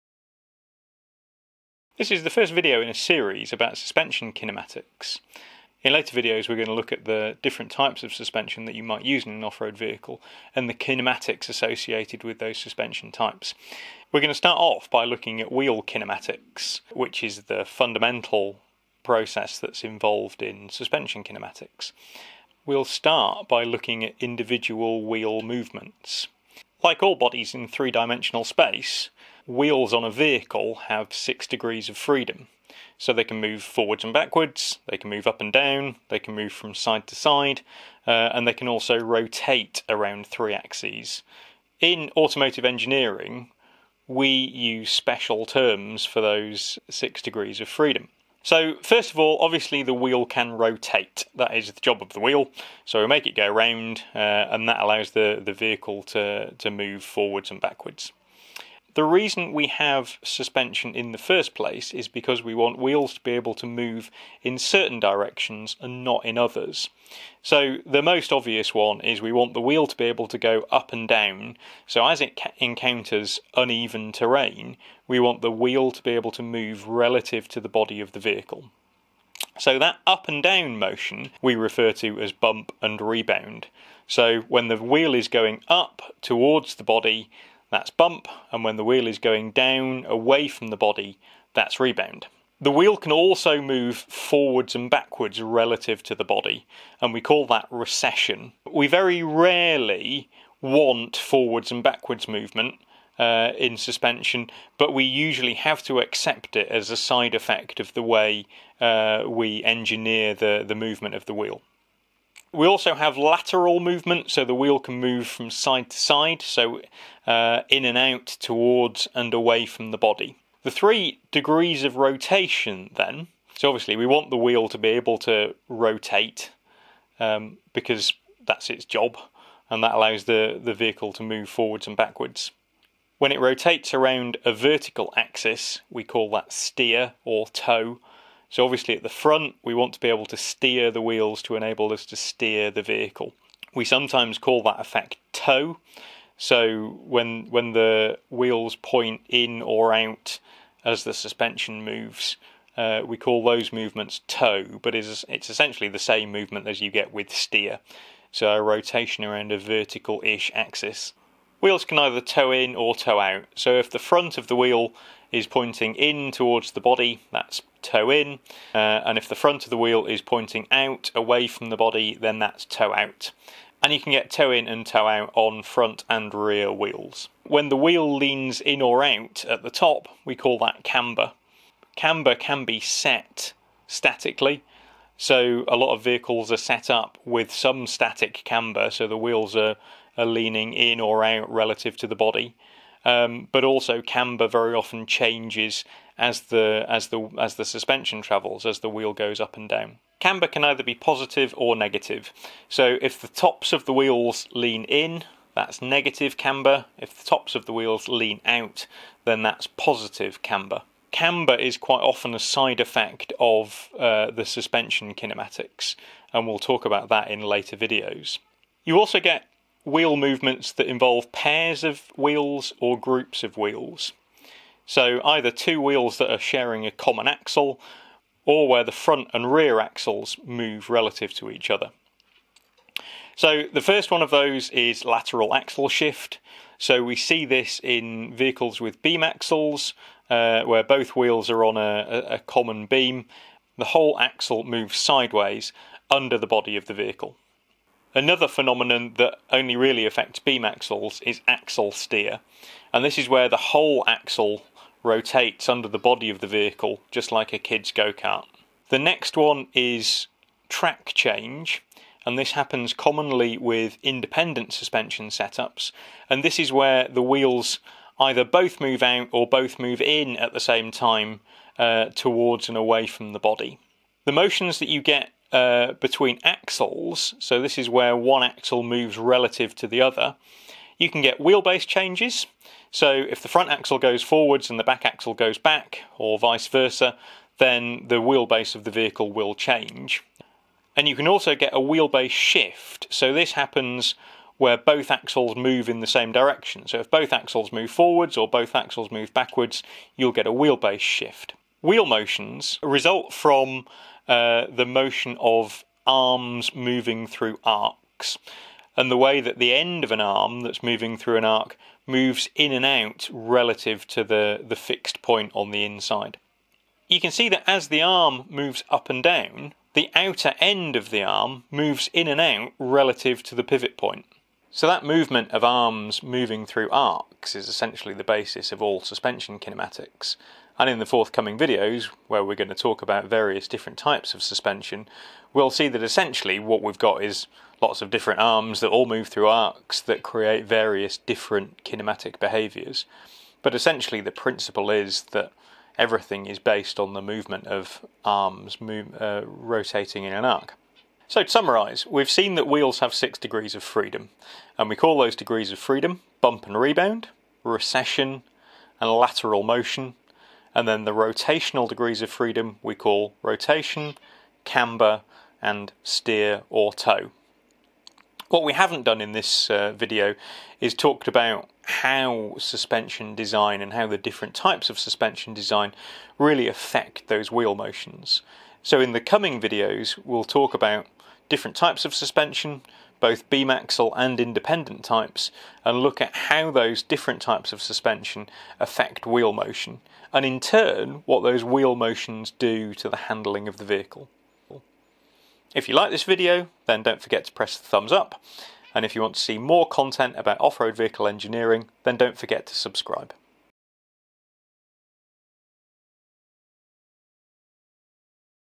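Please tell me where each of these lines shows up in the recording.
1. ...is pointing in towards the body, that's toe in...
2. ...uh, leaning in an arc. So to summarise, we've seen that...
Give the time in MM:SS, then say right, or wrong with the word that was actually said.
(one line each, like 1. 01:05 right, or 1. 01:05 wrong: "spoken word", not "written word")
1. 02:45 right
2. 05:49 wrong: "rotating", not "leaning".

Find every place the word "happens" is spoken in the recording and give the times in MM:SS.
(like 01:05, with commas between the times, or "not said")
04:22, 04:53.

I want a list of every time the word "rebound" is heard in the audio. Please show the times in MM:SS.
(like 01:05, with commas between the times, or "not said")
01:22, 01:31, 05:56.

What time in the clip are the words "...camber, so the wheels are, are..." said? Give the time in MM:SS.
03:08.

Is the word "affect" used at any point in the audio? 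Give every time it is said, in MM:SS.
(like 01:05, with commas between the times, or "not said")
04:10, 06:16, 06:28.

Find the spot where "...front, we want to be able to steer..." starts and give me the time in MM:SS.
02:19.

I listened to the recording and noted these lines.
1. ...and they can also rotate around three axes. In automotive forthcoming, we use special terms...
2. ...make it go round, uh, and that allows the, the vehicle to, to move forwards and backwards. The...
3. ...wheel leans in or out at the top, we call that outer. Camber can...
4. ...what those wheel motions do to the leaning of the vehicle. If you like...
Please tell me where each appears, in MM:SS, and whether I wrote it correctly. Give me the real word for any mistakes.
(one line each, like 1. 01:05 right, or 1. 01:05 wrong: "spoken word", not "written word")
1. 00:38 wrong: "engineering", not "forthcoming"
2. 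00:53 right
3. 02:57 wrong: "camber", not "outer"
4. 06:31 wrong: "handling", not "leaning".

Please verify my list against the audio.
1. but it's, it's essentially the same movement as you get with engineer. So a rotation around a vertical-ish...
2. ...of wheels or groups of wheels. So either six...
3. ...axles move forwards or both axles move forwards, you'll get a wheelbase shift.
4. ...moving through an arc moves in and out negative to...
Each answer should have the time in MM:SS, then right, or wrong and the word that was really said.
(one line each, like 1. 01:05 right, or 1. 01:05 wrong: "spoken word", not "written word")
1. 02:34 wrong: "steer", not "engineer"
2. 03:41 wrong: "two", not "six"
3. 04:57 wrong: "backwards", not "forwards"
4. 05:10 wrong: "relative", not "negative".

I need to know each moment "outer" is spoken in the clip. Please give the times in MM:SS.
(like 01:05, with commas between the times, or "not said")
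05:20.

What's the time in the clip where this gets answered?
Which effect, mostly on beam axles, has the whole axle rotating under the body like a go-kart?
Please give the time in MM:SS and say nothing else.
04:11.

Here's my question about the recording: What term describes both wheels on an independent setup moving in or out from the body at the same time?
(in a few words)
Track change.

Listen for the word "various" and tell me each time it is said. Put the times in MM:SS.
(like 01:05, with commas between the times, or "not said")
05:33, 05:40.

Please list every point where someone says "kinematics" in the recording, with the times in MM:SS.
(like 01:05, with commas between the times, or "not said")
00:04, 00:10, 00:15, 00:21, 03:35, 05:29, 05:41.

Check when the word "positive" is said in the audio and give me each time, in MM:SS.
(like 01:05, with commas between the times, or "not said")
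03:20, 03:29.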